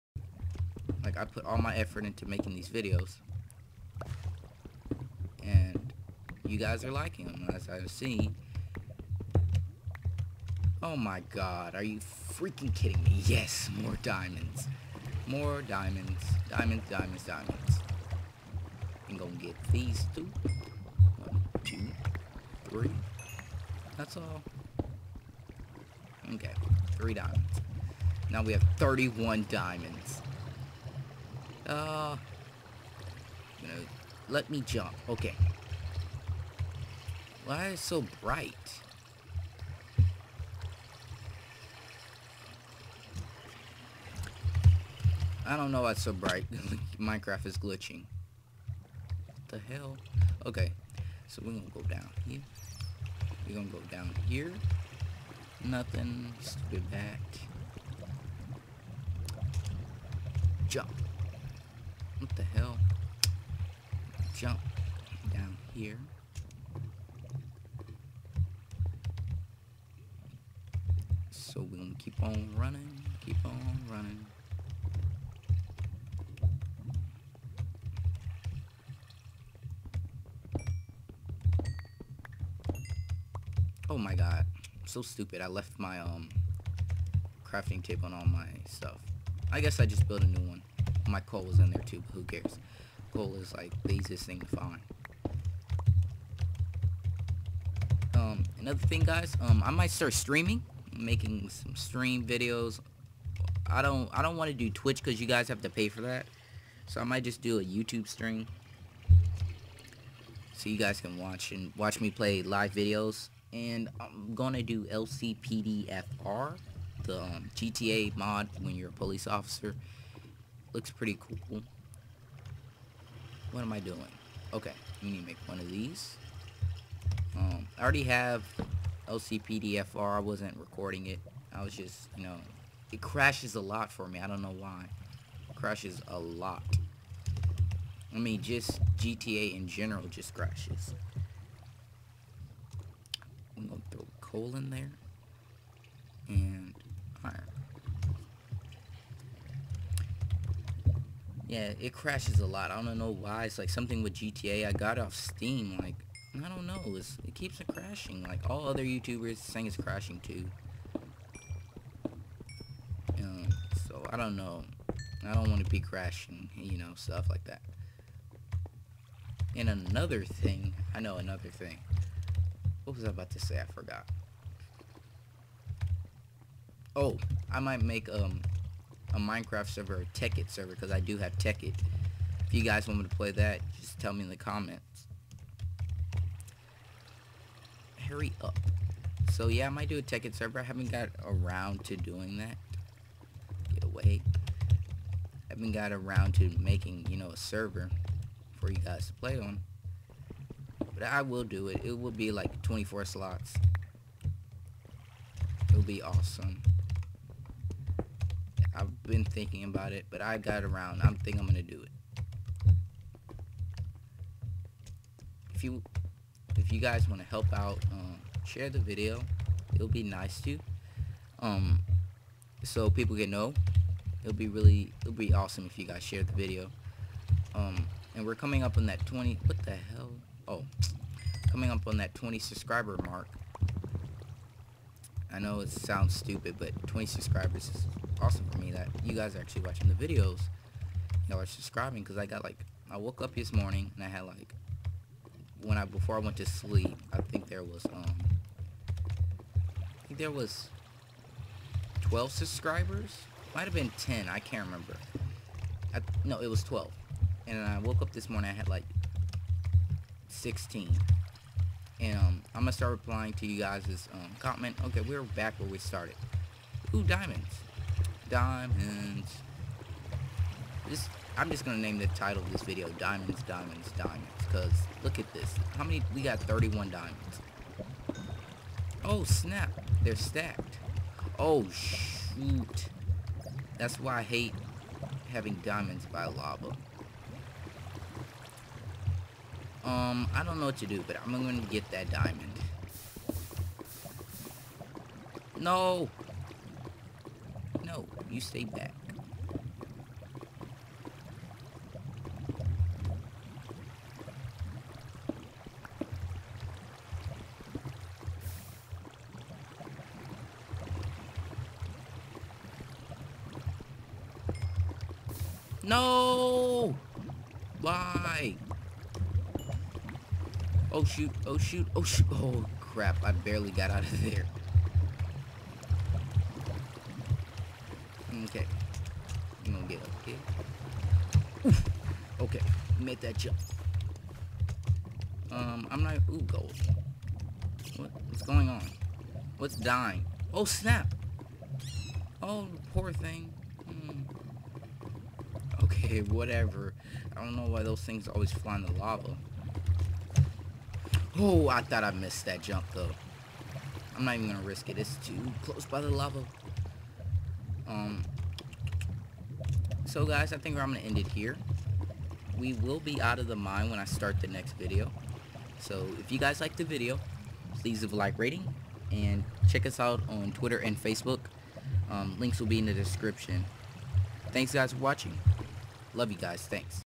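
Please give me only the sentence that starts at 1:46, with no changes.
So I might just do a YouTube stream.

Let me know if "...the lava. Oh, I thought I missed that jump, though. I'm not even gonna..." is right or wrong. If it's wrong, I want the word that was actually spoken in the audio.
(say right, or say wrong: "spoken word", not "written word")
right.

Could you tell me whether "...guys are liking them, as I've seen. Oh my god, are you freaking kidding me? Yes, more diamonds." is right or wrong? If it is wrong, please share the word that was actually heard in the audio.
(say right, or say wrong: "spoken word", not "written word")
right.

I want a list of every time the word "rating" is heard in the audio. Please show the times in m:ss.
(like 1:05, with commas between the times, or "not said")
6:08.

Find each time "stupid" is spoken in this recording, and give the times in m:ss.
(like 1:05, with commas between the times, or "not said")
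0:56, 1:25, 3:56.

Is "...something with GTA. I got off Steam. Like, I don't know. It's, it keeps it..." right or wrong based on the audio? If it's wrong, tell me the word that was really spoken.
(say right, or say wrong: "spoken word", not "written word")
right.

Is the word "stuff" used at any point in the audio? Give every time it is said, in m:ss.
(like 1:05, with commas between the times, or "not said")
1:28, 2:46.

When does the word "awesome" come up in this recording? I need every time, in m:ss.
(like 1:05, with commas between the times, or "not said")
3:26, 3:45, 3:58.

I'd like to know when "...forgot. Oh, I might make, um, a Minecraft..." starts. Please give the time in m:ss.
2:53.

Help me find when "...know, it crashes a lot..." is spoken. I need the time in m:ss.
2:12.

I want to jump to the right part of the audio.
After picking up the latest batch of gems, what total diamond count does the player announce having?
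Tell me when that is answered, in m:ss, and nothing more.
0:28.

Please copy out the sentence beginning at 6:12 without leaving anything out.
Um, links will be in the description.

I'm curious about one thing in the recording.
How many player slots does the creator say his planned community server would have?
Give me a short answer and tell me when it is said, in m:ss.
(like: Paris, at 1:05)
24, at 3:22.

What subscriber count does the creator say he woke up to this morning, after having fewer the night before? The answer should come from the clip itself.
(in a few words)
16.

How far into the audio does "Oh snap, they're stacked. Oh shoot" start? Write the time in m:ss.
4:39.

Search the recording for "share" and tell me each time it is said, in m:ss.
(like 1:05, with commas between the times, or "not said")
3:38, 3:46.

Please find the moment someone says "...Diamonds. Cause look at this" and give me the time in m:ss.
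4:33.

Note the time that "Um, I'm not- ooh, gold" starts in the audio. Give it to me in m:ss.
5:35.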